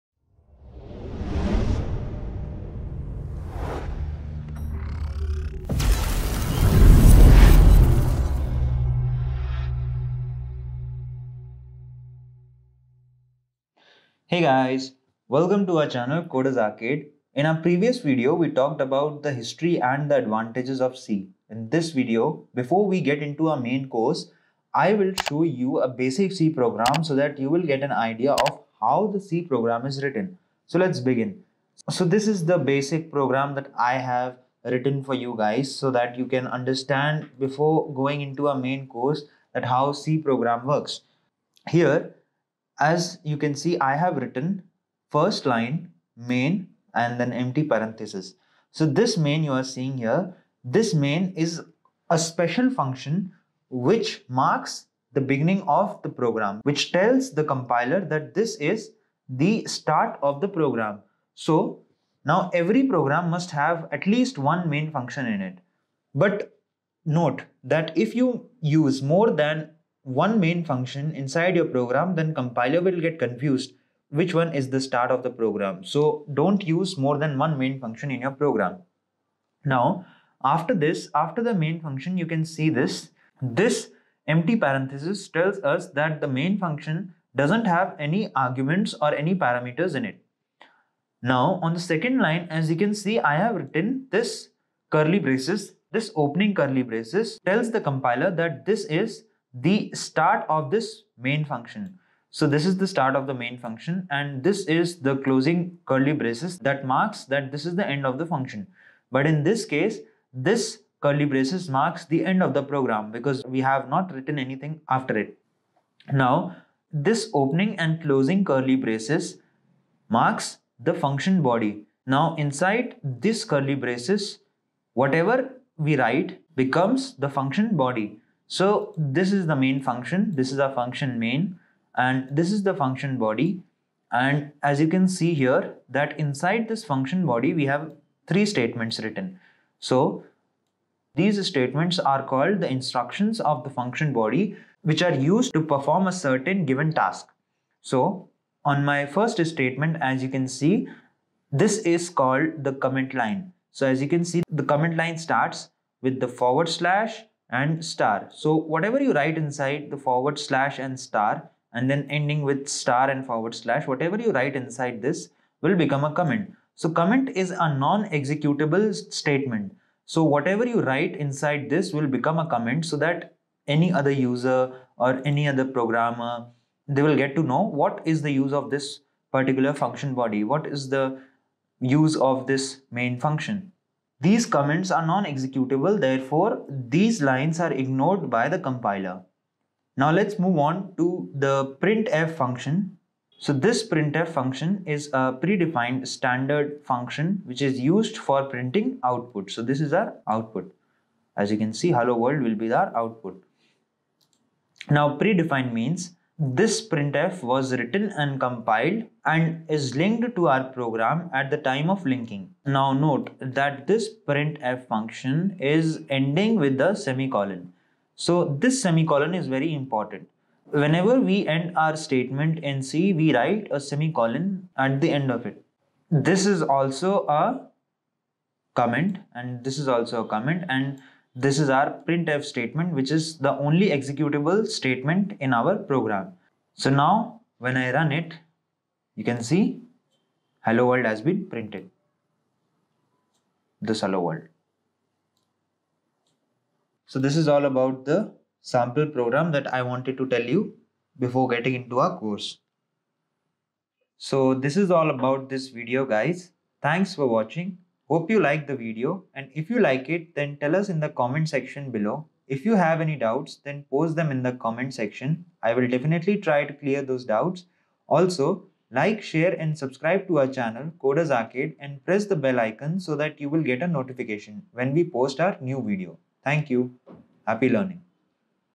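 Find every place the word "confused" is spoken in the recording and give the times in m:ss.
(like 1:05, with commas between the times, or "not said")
1:13.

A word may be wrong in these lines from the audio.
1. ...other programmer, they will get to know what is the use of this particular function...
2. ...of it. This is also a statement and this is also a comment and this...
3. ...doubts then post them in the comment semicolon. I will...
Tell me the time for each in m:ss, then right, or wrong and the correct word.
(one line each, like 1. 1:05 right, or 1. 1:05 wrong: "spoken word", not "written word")
1. 2:55 right
2. 3:45 wrong: "comment", not "statement"
3. 4:23 wrong: "section", not "semicolon".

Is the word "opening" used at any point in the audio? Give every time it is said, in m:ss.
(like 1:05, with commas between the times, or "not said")
1:36, 1:57.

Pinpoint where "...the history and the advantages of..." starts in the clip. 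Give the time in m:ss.
0:19.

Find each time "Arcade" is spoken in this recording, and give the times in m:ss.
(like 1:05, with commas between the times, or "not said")
0:16, 4:31.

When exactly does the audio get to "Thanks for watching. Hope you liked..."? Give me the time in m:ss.
4:16.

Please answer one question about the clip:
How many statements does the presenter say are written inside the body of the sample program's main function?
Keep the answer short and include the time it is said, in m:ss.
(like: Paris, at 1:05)
3, at 2:18.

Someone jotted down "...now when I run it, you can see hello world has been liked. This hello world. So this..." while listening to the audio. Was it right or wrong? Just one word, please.
wrong.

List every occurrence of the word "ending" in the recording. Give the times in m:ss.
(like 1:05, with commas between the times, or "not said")
2:42, 3:36.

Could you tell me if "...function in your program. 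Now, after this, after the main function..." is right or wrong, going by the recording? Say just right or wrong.
right.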